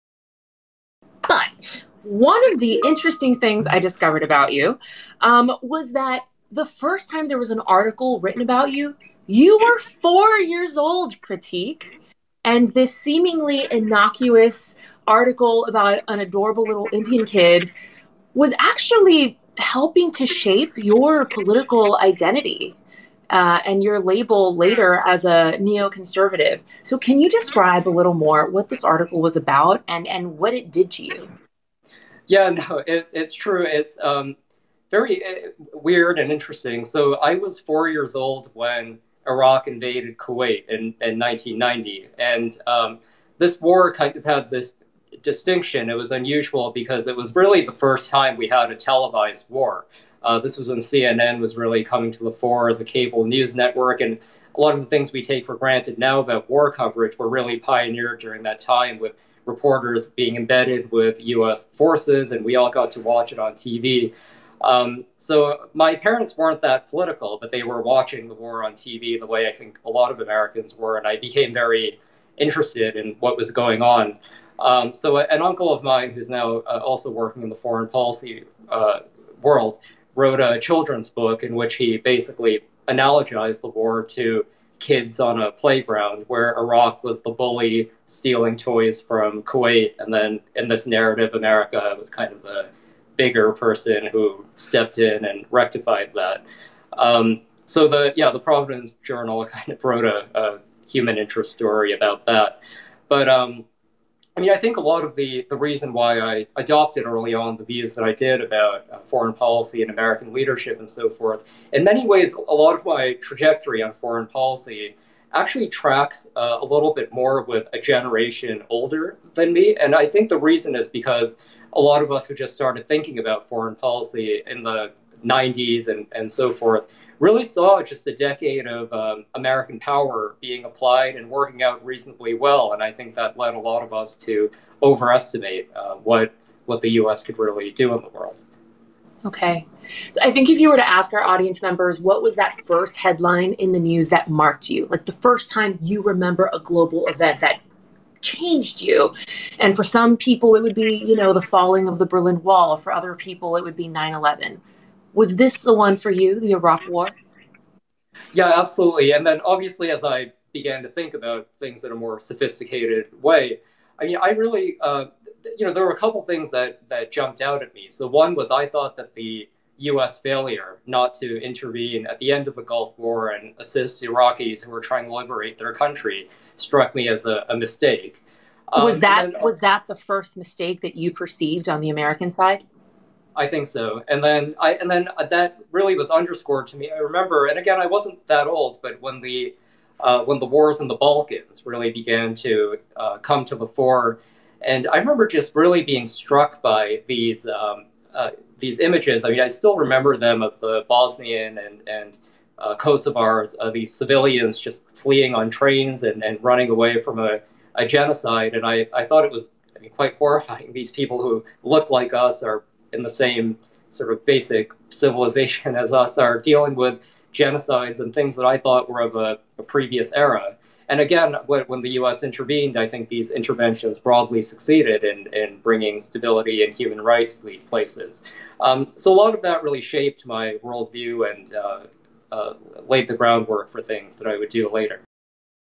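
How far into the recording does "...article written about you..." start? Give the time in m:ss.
0:07.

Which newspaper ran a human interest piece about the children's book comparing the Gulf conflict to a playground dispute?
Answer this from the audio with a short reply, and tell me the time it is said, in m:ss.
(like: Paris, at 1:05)
Providence Journal, at 1:38.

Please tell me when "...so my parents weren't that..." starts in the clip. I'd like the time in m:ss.
1:05.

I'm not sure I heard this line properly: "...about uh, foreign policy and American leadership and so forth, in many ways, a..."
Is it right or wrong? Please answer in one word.
right.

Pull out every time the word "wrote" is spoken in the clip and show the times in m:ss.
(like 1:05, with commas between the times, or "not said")
1:20, 1:39.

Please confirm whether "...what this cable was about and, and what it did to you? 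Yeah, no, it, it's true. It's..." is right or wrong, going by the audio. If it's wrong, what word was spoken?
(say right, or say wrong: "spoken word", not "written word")
wrong: "article", not "cable".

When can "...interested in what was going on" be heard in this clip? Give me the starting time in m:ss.
1:12.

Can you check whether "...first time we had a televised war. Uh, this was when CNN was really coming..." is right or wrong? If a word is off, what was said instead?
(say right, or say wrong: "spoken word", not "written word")
right.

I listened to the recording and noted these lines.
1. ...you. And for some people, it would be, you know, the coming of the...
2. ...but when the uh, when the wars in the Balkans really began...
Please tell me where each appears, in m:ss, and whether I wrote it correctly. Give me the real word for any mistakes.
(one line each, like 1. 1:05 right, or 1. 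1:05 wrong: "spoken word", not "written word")
1. 2:28 wrong: "falling", not "coming"
2. 3:08 right.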